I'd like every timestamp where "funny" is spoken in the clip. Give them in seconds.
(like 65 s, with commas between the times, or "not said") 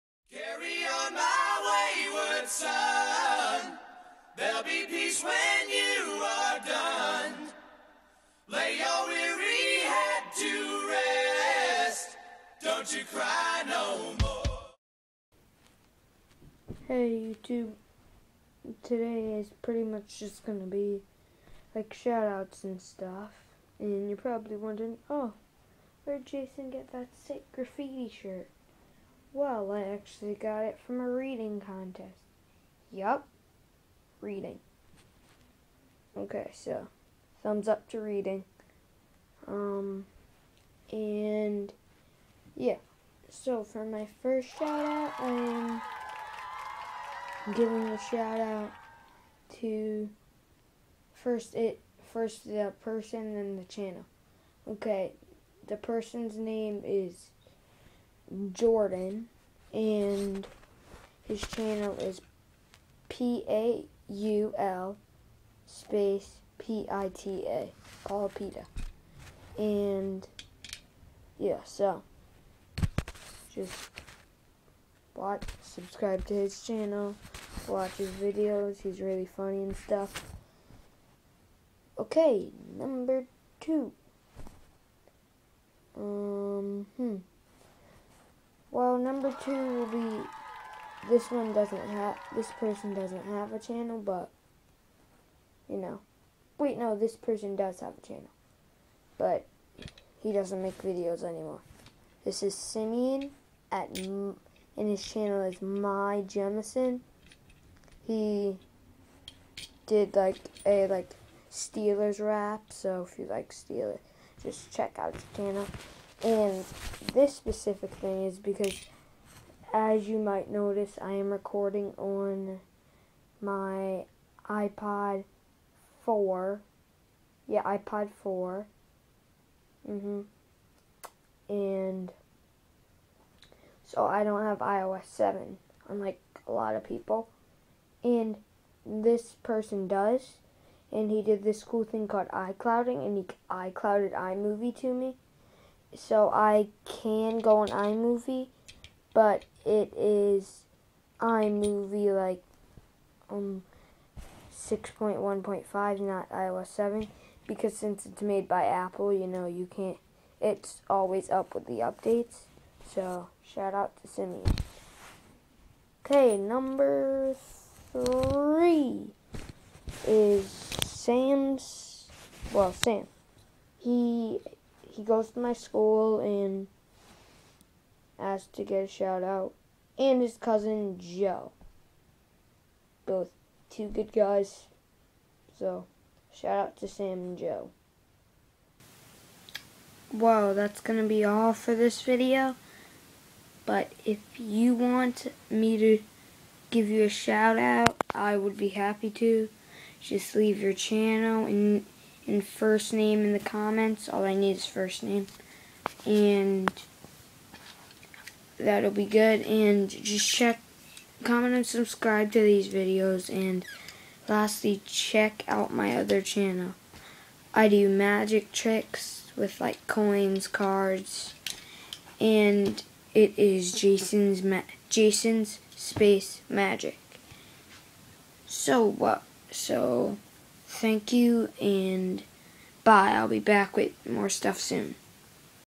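79 s.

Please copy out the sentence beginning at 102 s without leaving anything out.
This is Simeon at and his channel is My Jemison.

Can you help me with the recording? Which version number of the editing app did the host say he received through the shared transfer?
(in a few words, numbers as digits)
6.1.5.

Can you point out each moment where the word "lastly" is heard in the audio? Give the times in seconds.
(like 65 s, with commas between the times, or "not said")
214 s.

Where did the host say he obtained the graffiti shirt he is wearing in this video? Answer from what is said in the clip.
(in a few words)
A reading contest.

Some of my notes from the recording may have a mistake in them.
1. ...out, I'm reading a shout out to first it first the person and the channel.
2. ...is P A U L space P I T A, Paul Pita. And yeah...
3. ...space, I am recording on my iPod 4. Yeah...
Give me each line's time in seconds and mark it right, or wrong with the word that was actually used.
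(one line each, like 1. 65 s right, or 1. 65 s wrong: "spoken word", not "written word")
1. 44 s wrong: "giving", not "reading"
2. 61 s right
3. 120 s wrong: "notice", not "space".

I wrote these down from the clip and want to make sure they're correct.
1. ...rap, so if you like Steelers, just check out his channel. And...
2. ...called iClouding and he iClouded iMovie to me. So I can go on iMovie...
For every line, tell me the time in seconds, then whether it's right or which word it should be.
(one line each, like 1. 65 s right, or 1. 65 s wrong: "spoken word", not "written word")
1. 112 s right
2. 142 s right.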